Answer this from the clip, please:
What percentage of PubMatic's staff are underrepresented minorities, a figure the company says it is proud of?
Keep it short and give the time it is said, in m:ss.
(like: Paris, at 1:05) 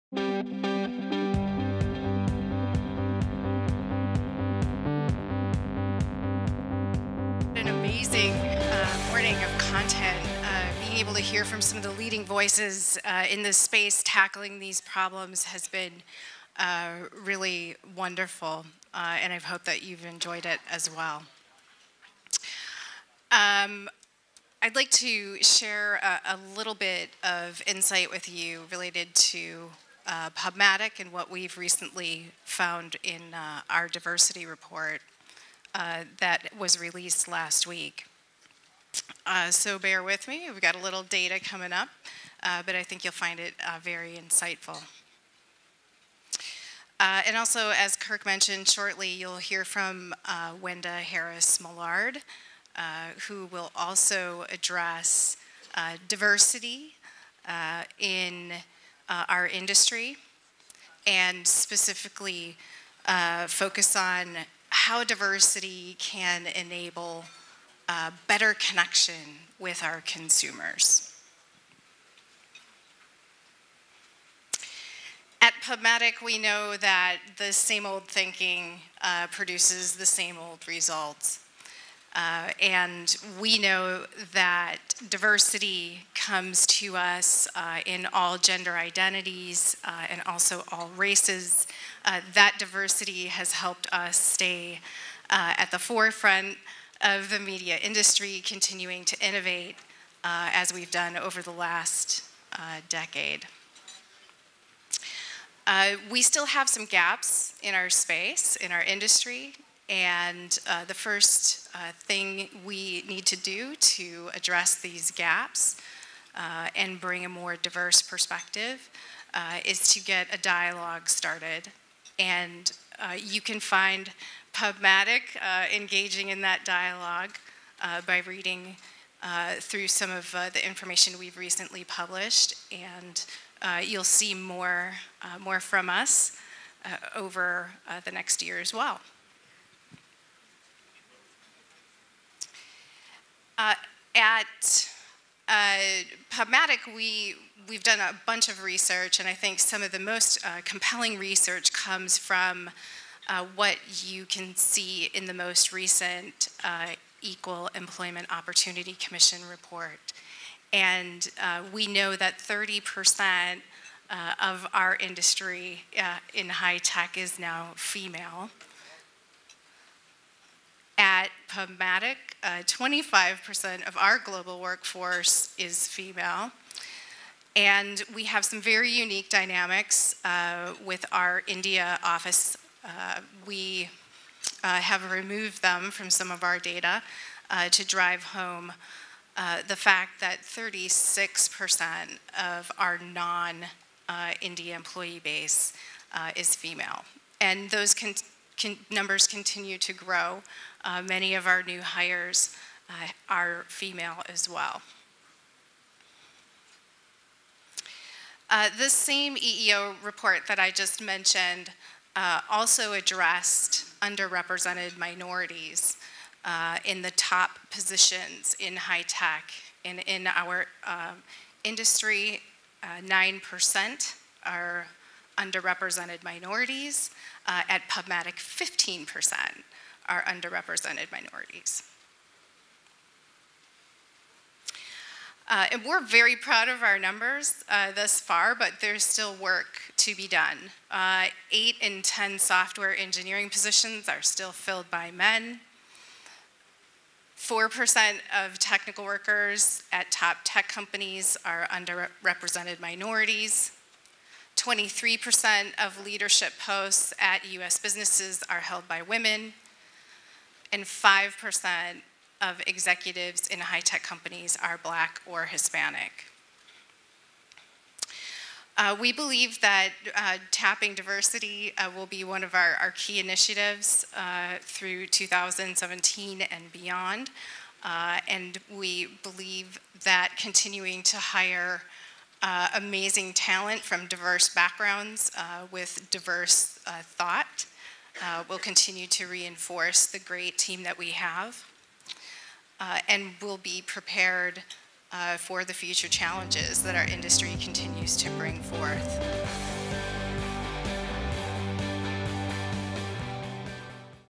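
15%, at 3:48.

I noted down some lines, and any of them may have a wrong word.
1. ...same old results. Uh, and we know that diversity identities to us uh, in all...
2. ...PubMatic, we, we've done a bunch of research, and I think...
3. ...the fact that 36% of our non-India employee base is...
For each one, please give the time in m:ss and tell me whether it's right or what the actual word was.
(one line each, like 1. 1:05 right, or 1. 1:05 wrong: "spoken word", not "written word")
1. 1:20 wrong: "comes", not "identities"
2. 2:26 right
3. 3:09 right.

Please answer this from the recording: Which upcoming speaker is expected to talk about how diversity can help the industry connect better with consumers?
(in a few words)
Wenda Harris Millard.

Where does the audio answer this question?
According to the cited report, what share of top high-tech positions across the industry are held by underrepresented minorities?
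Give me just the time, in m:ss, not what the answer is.
3:42.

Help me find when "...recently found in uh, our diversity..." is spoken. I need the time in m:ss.
0:31.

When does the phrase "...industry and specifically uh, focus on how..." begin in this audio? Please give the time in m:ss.
0:59.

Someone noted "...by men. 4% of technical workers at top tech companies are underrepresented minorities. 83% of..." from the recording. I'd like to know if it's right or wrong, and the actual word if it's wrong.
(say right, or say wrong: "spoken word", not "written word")
wrong: "23", not "83".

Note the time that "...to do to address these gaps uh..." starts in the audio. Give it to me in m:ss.
1:53.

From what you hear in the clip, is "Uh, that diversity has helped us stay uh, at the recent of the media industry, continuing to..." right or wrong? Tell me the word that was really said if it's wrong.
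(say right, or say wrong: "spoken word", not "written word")
wrong: "forefront", not "recent".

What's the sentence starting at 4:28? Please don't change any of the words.
Uh, we believe that uh, tapping diversity uh, will be one of our, our key initiatives uh, through 2017 and beyond.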